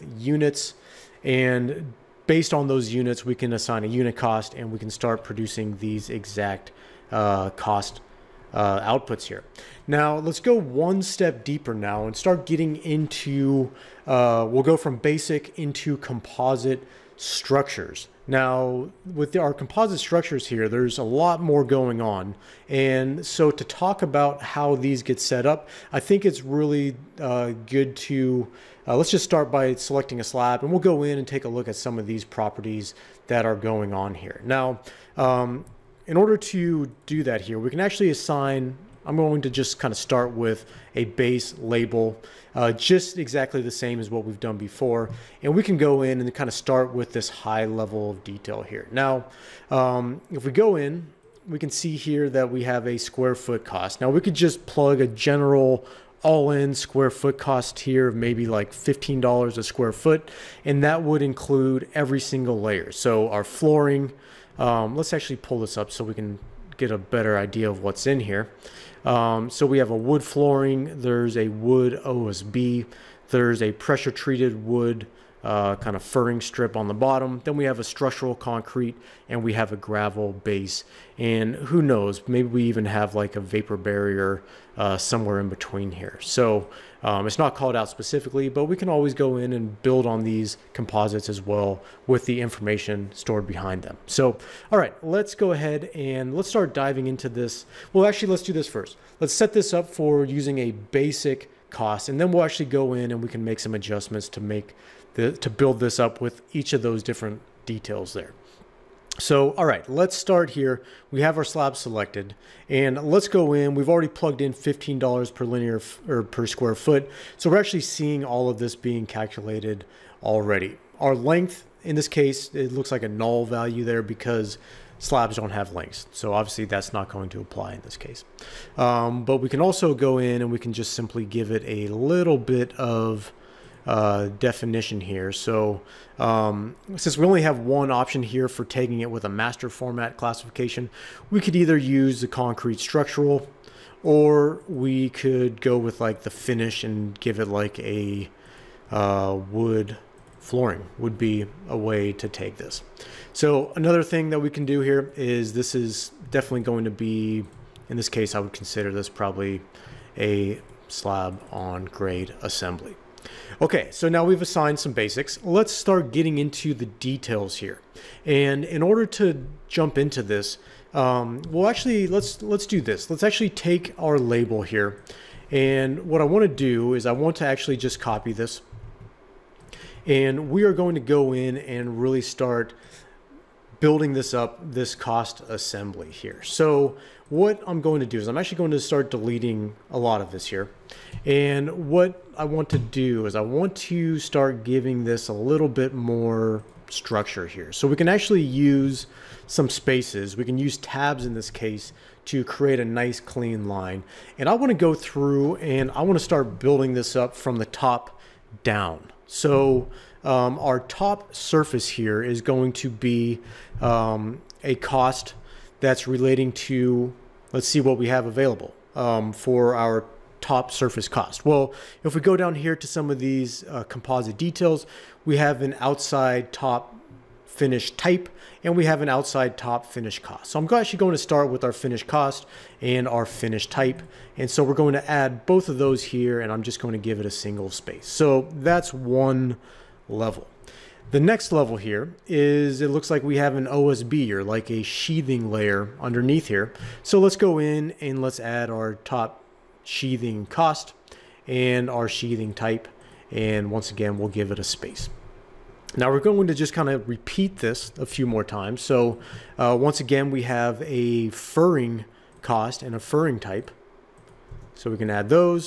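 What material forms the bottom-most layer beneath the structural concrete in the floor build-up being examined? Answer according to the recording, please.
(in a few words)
gravel base.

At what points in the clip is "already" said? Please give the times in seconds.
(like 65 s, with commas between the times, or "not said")
113 s, 120 s.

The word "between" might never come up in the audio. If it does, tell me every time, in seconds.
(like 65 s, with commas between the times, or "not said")
85 s.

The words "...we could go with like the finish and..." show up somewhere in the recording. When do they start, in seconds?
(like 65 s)
144 s.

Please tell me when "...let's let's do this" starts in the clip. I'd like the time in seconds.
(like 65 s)
172 s.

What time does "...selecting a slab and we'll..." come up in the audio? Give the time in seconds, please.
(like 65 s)
29 s.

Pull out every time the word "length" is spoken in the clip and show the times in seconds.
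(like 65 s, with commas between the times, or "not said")
121 s, 125 s.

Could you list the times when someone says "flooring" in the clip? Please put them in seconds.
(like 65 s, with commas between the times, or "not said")
63 s, 70 s, 150 s.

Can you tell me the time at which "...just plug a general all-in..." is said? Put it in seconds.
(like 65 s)
54 s.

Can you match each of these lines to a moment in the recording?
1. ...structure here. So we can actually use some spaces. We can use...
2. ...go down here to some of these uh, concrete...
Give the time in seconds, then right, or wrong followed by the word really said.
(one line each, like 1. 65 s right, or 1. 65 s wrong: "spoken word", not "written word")
1. 196 s right
2. 222 s wrong: "composite", not "concrete".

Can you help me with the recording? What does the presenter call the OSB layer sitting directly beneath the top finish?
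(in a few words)
sheathing layer.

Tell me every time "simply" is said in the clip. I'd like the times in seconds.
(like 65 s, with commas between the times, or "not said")
130 s.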